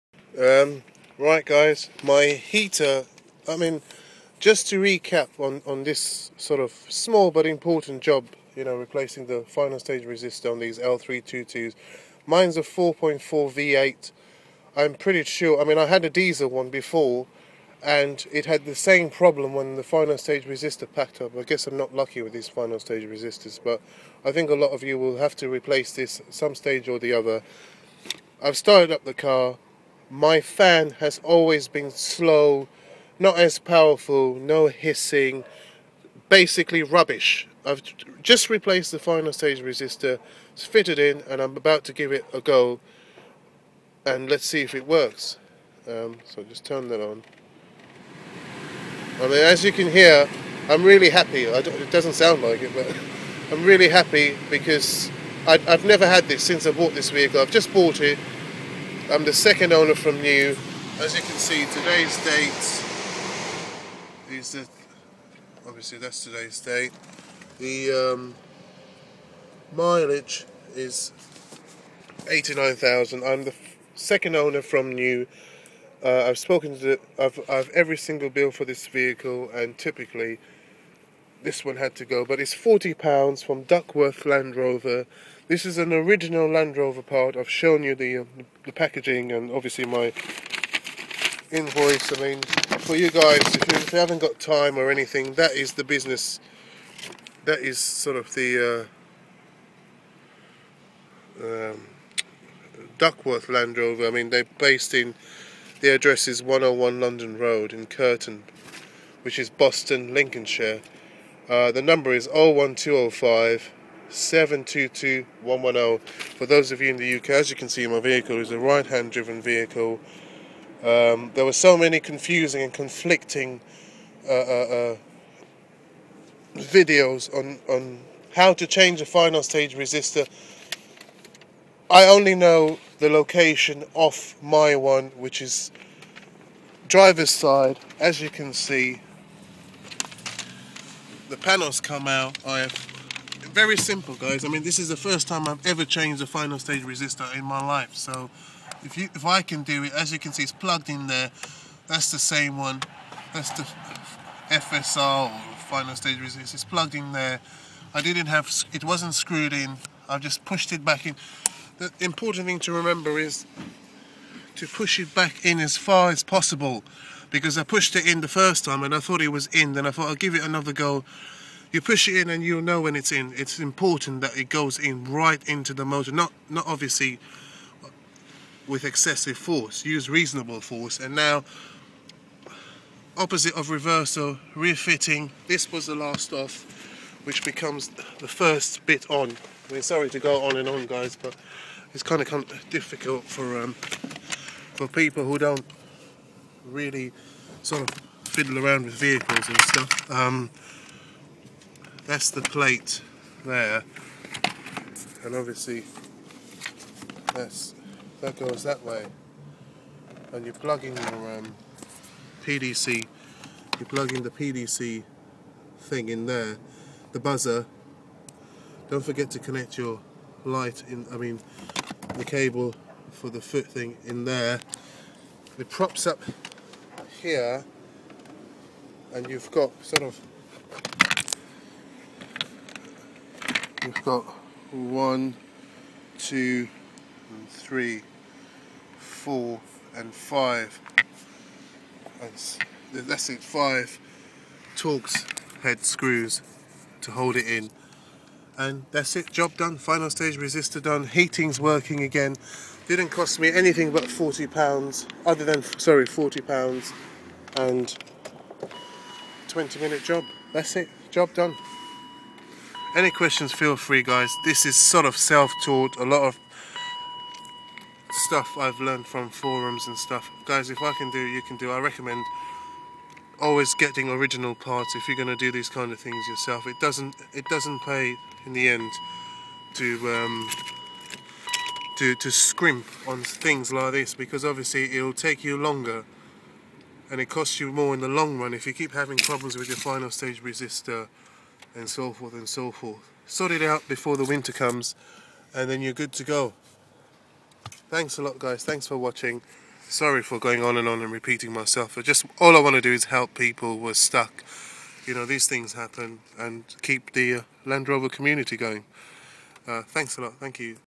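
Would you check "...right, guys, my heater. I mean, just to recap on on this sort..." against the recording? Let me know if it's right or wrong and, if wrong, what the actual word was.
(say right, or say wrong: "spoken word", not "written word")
right.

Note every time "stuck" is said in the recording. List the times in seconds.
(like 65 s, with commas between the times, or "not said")
303 s.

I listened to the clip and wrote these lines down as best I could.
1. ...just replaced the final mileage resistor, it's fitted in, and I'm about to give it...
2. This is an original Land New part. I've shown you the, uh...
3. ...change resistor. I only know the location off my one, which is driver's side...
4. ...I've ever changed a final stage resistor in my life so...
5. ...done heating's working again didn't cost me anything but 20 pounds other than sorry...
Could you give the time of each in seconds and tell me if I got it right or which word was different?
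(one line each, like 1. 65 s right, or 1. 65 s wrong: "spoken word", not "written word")
1. 38 s wrong: "stage", not "mileage"
2. 85 s wrong: "Rover", not "New"
3. 129 s wrong: "stage", not "change"
4. 145 s right
5. 250 s wrong: "40", not "20".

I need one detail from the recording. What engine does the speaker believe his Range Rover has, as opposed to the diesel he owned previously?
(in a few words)
4.4 V8.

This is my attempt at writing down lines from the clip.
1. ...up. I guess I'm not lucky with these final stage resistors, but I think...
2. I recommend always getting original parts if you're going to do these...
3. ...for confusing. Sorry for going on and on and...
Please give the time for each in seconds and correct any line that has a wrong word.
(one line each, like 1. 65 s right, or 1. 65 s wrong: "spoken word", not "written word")
1. 21 s right
2. 271 s right
3. 298 s wrong: "watching", not "confusing".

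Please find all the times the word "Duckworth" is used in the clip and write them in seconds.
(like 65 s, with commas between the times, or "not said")
83 s, 102 s.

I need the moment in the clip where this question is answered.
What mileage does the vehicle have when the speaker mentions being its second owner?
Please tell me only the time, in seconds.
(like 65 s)
72 s.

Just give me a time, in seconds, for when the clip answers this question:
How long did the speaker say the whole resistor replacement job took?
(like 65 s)
259 s.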